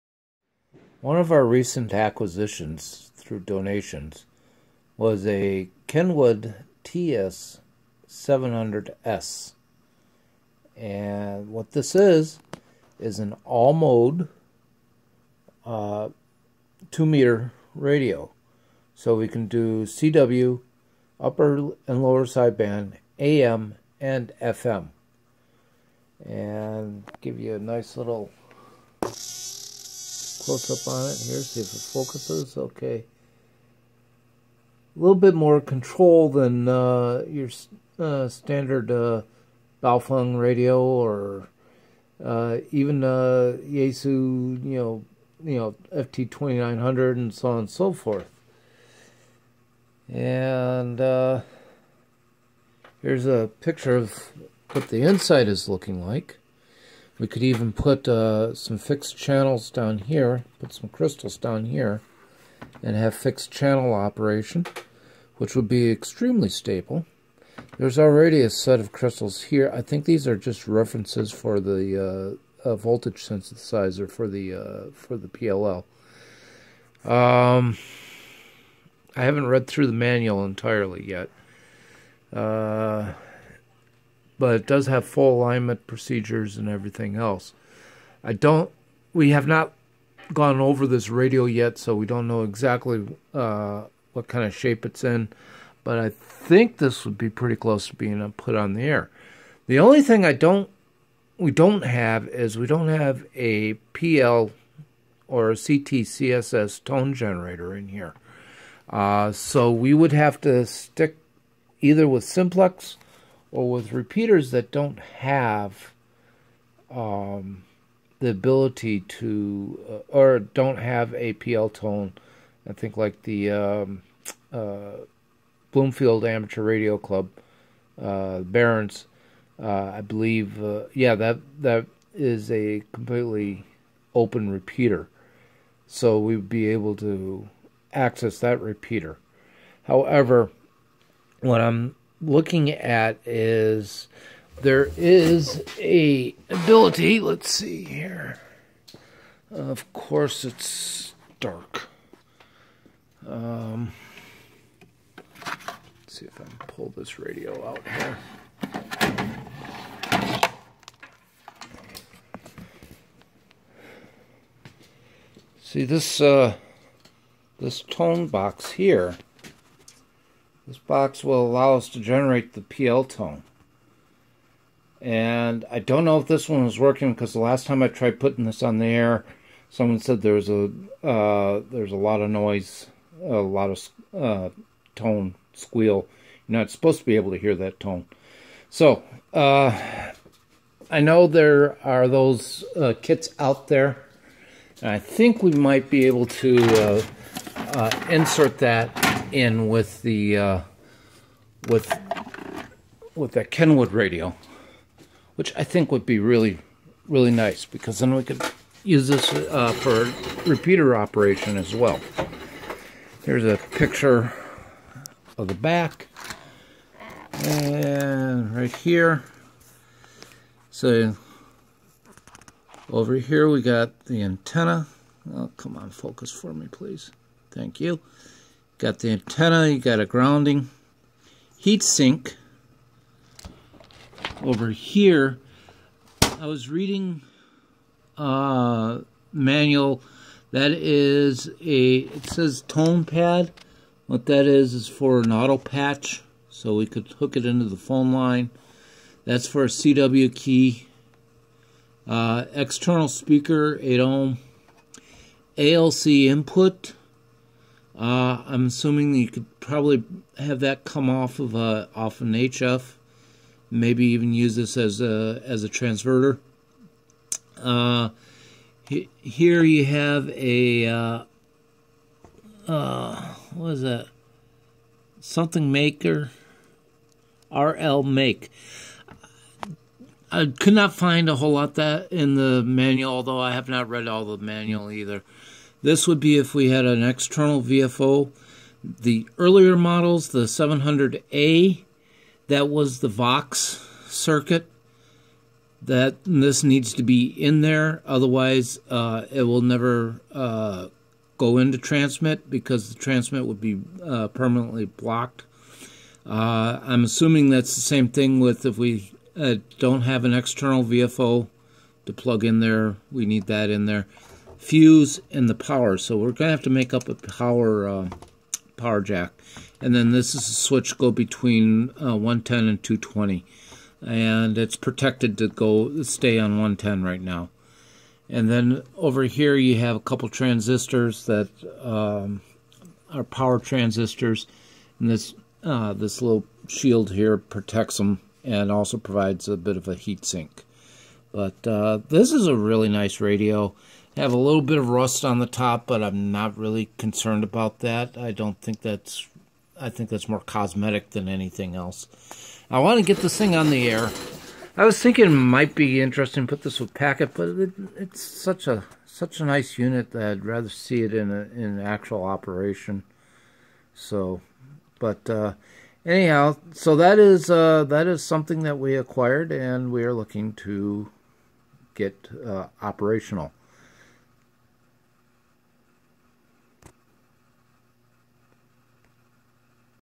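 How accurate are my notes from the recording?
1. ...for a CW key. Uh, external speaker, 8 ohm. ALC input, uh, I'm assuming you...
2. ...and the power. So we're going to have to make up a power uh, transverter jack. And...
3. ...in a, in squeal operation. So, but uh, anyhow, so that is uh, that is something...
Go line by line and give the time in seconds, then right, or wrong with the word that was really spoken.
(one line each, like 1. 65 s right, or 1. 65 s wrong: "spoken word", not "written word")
1. 249 s right
2. 315 s wrong: "power", not "transverter"
3. 361 s wrong: "actual", not "squeal".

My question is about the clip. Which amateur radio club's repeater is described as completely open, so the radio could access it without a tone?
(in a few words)
Bloomfield Amateur Radio Club.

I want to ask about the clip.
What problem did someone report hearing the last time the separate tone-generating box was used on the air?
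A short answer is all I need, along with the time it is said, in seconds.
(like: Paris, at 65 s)
tone squeal, at 184 s.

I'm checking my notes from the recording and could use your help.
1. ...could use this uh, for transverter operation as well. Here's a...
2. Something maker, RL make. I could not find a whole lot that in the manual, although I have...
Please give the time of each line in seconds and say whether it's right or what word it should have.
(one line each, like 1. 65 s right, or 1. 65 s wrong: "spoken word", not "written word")
1. 208 s wrong: "repeater", not "transverter"
2. 275 s right.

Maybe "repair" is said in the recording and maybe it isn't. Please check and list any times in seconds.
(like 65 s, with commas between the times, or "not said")
not said.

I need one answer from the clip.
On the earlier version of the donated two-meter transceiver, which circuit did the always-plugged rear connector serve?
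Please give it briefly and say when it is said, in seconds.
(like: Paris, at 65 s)
Vox circuit, at 293 s.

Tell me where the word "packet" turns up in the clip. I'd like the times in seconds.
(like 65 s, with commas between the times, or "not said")
356 s.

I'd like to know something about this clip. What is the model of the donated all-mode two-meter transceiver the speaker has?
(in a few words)
Kenwood TS 700S.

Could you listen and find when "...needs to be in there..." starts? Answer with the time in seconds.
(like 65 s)
296 s.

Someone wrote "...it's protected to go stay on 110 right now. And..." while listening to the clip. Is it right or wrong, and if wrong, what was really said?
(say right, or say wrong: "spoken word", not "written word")
right.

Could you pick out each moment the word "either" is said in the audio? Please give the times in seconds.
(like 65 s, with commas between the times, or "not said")
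111 s, 284 s.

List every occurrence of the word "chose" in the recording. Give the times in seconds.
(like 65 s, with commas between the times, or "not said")
not said.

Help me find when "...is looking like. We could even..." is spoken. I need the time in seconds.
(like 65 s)
55 s.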